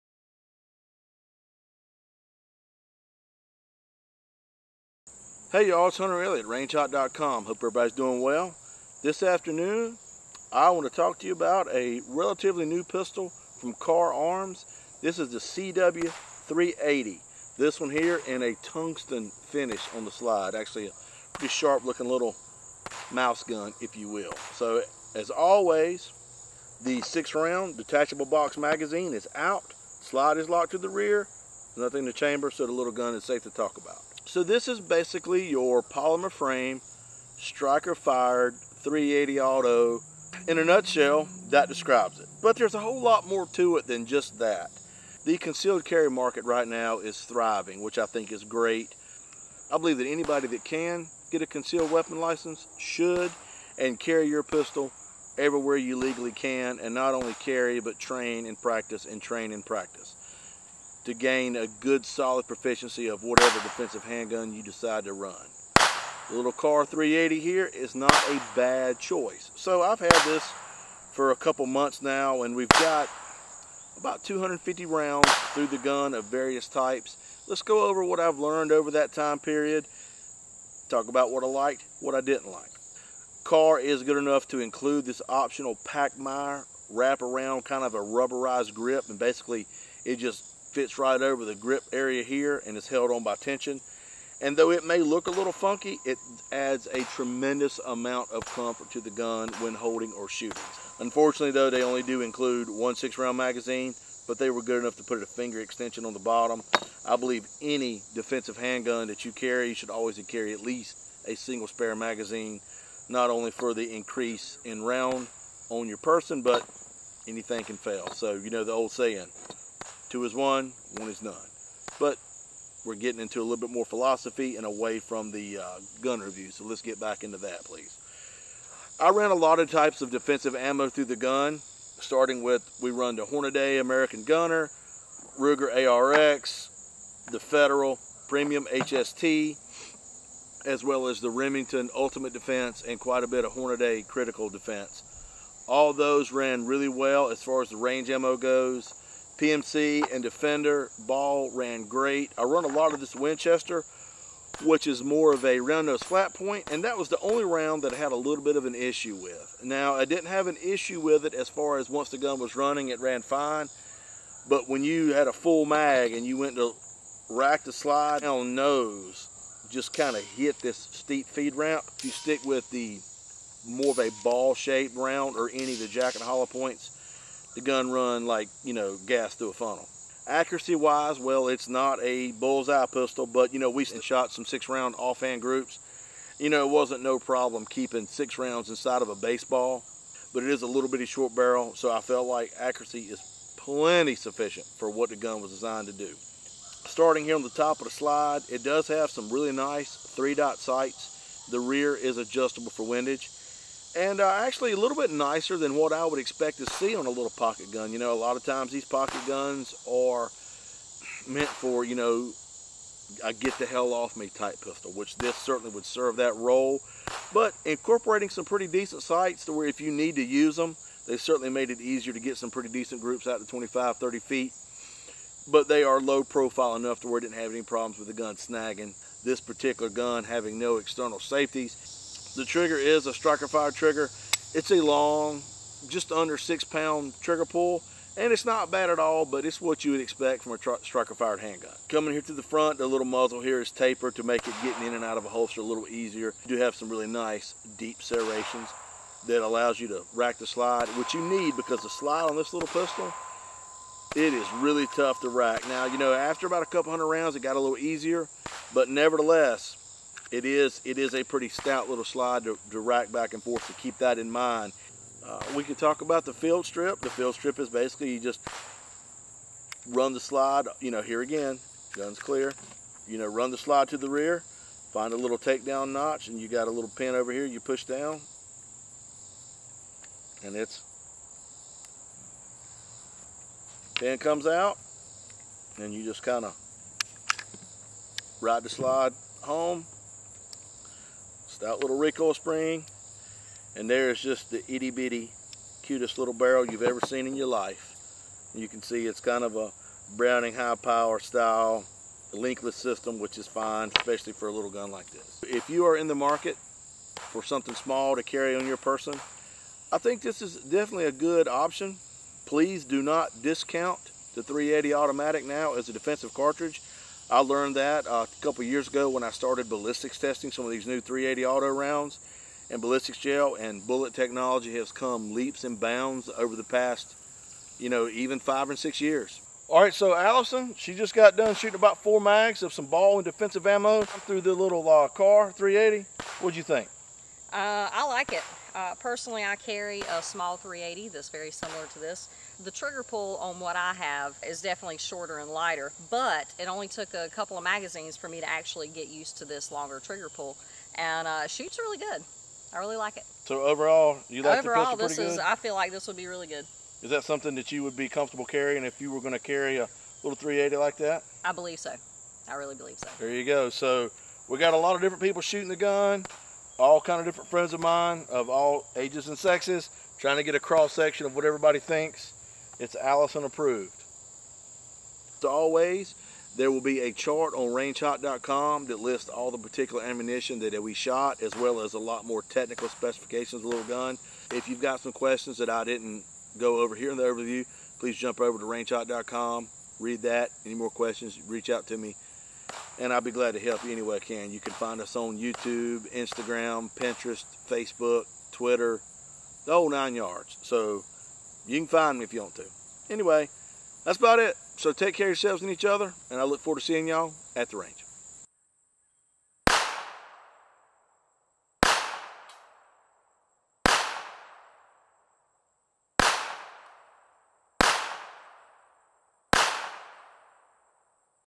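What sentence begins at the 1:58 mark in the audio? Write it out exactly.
So, you know the old saying, Two is one, one is none.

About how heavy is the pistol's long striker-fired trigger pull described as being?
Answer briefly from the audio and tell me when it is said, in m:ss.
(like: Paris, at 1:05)
Just under 6 pounds, at 3:55.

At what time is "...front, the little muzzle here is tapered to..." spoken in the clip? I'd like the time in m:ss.
4:02.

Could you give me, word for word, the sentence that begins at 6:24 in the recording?
If you've got some questions that I didn't go over here in the overview, please jump over to rangeHot.com, read that.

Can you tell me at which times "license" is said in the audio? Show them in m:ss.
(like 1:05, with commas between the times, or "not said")
0:52.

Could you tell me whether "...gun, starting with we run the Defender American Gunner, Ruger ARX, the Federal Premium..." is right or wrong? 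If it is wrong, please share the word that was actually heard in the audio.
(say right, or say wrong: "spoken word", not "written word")
wrong: "Hornady", not "Defender".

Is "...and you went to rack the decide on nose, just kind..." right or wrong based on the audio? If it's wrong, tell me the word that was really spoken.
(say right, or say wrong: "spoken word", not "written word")
wrong: "slide", not "decide".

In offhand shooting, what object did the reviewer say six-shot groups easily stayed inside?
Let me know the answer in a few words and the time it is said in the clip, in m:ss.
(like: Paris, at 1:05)
A baseball, at 3:09.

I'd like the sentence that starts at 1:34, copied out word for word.
And though it may look a little funky, it adds a tremendous amount of comfort to the gun when holding or shooting.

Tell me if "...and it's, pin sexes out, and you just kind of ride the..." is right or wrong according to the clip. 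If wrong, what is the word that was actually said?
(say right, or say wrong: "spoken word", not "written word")
wrong: "comes", not "sexes".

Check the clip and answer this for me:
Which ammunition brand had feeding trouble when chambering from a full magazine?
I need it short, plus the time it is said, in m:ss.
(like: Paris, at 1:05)
Winchester, at 2:33.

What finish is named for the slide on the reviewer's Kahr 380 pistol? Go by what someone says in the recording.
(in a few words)
Tungsten.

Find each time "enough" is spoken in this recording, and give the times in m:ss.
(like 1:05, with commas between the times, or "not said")
1:24, 1:44, 3:46.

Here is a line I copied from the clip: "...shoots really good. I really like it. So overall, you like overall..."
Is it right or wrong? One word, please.
right.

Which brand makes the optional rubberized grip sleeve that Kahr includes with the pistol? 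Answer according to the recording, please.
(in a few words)
Pachmayr.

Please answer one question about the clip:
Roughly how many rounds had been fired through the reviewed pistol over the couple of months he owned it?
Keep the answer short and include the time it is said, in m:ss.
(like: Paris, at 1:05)
250, at 1:14.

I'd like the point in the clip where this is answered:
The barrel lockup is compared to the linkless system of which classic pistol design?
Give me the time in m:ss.
5:00.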